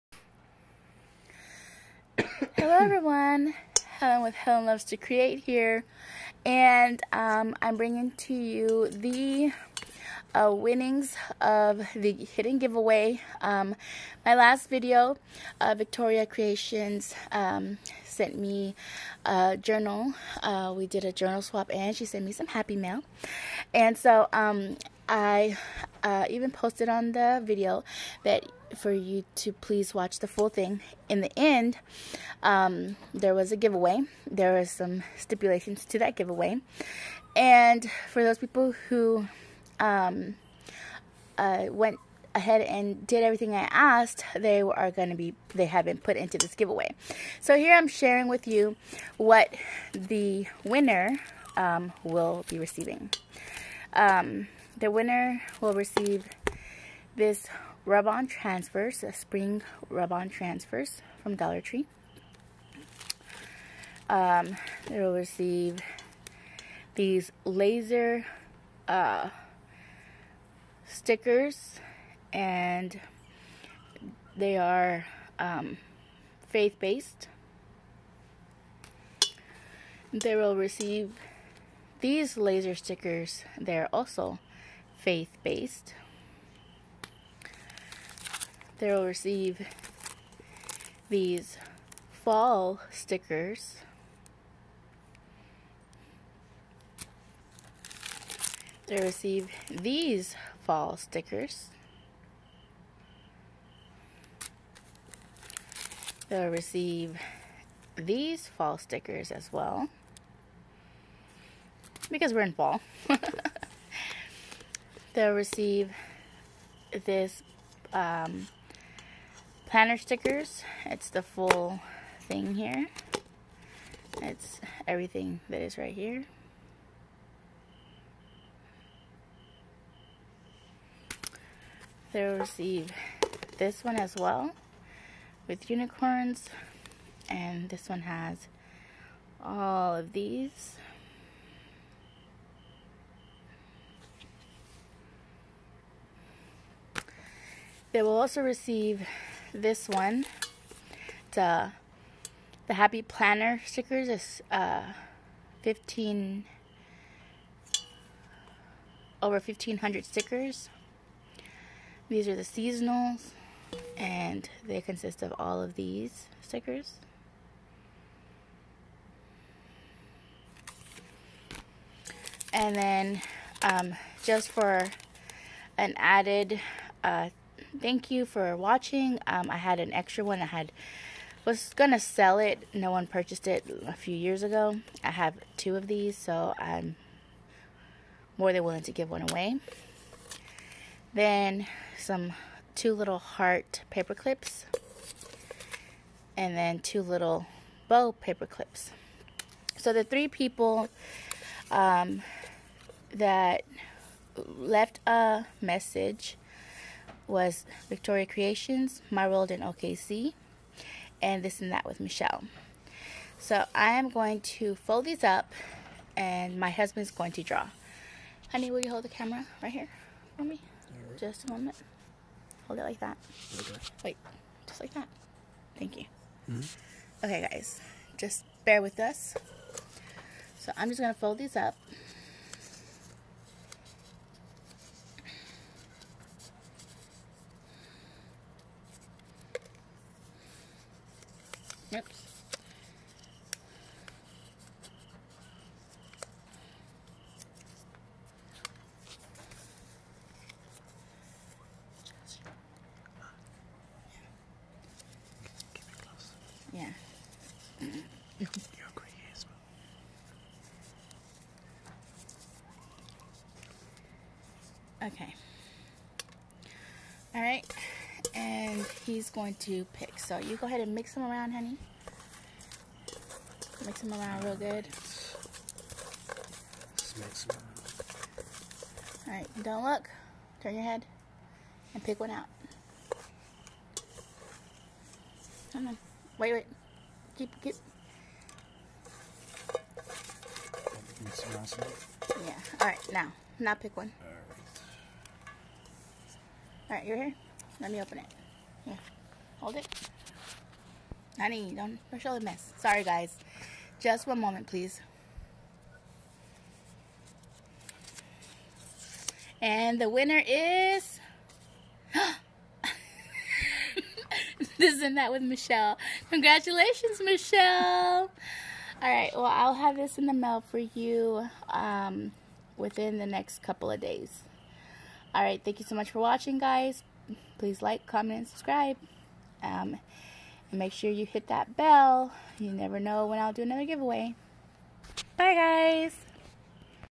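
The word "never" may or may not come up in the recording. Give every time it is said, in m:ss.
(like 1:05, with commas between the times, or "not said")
5:32.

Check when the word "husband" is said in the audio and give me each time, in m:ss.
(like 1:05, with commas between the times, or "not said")
3:36.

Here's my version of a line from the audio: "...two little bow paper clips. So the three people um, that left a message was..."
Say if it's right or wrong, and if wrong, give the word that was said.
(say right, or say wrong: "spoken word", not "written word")
right.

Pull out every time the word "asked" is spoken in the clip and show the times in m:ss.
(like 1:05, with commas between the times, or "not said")
0:43.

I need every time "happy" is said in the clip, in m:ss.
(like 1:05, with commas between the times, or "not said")
0:22, 2:32.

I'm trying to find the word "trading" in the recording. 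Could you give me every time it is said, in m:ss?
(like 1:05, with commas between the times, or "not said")
not said.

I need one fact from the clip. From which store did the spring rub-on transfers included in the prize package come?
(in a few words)
Dollar Tree.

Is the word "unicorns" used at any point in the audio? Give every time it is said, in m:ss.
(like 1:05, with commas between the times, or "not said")
2:15.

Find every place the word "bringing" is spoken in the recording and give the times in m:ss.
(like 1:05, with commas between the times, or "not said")
0:07.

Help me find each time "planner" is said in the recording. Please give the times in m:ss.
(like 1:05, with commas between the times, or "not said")
1:59, 2:33.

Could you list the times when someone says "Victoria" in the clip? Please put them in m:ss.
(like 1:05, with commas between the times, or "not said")
0:15, 3:27.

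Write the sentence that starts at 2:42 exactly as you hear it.
These are the seasonals and they consist of all of these stickers.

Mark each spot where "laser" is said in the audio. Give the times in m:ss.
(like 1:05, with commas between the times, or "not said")
1:07, 1:22.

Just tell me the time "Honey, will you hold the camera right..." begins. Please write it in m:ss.
3:38.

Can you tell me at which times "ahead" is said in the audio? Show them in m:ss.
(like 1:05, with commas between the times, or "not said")
0:42, 4:30.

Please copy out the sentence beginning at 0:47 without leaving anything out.
So here I'm sharing with you what the winner um, will be receiving.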